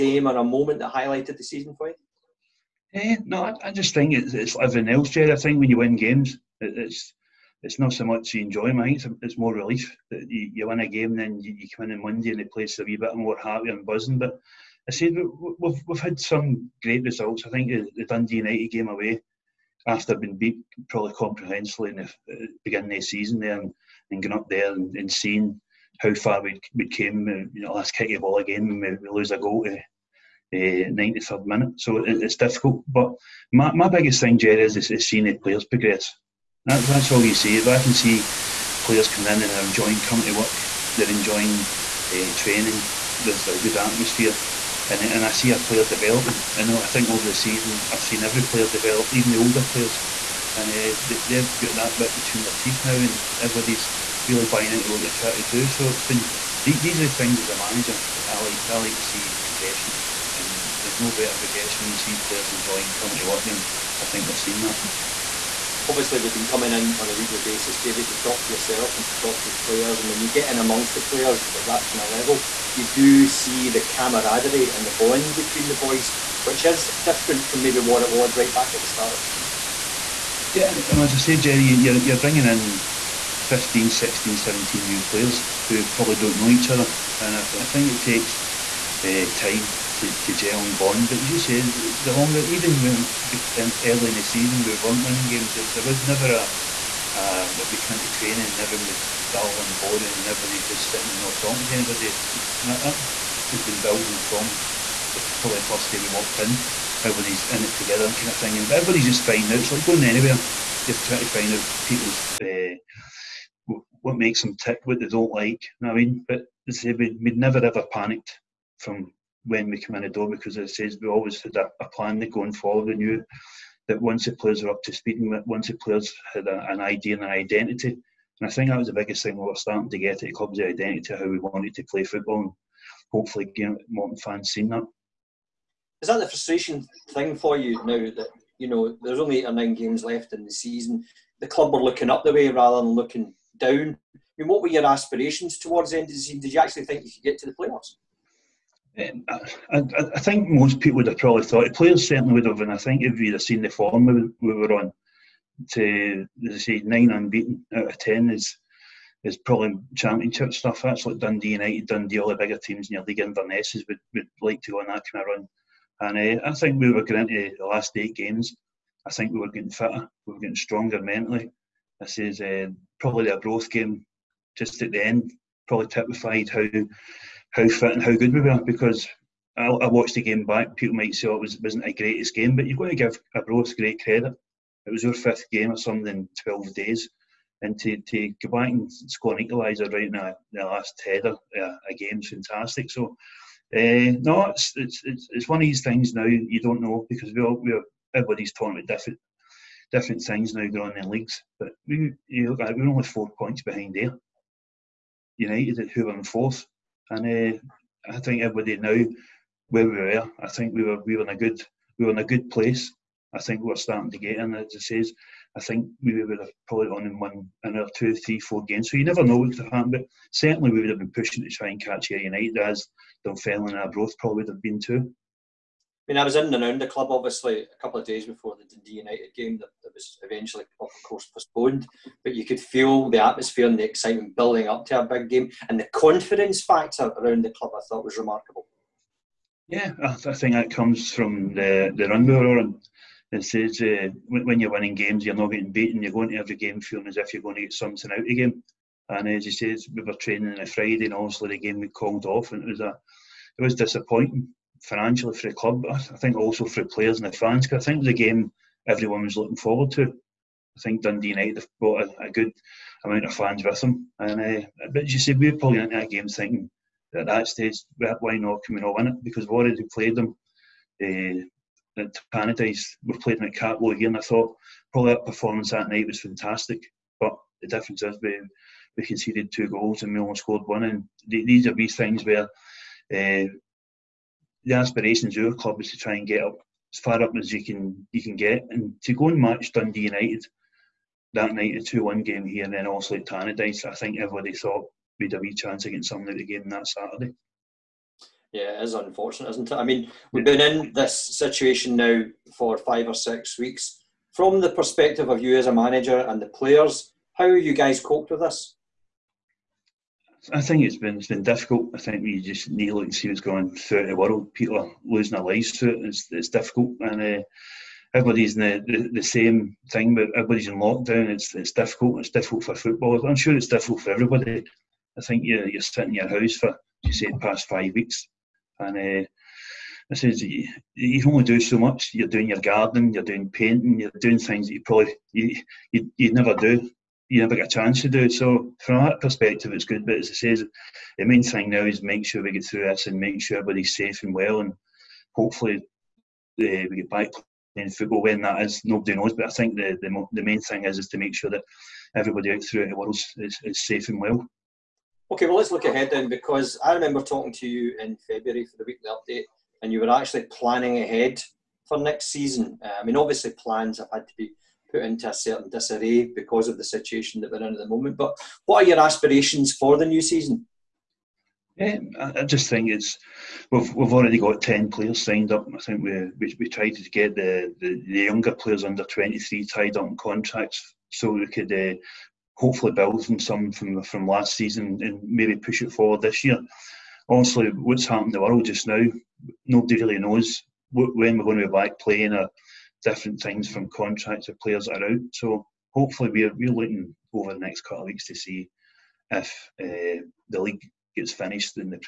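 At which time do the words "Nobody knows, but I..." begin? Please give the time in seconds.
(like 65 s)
348 s.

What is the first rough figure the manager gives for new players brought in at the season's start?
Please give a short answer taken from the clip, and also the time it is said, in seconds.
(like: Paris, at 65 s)
15, at 83 s.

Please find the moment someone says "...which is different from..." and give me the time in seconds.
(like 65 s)
76 s.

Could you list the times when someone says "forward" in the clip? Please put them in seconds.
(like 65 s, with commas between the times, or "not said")
122 s, 259 s, 385 s.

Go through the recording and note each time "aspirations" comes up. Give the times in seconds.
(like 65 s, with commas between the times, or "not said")
144 s, 284 s, 368 s.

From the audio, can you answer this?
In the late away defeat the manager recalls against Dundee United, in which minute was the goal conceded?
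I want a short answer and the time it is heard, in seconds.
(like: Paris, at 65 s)
93rd minute, at 30 s.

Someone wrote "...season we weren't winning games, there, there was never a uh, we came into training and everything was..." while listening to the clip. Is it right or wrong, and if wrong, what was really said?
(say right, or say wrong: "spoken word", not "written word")
right.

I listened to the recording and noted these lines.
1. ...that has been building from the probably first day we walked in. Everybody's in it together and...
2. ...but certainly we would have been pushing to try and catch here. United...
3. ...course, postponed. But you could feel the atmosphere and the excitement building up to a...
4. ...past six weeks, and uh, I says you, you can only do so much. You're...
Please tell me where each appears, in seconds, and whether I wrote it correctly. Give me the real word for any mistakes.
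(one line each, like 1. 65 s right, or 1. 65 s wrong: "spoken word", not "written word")
1. 102 s right
2. 219 s right
3. 231 s right
4. 327 s wrong: "five", not "six".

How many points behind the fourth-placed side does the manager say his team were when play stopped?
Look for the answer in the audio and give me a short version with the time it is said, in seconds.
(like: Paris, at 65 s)
4 points, at 203 s.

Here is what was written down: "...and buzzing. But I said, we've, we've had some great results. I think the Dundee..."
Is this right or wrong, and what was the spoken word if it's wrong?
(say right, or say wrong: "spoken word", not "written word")
right.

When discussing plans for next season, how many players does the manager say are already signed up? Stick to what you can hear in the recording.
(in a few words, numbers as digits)
10.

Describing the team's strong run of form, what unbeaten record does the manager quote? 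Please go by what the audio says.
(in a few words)
9 unbeaten out of 10.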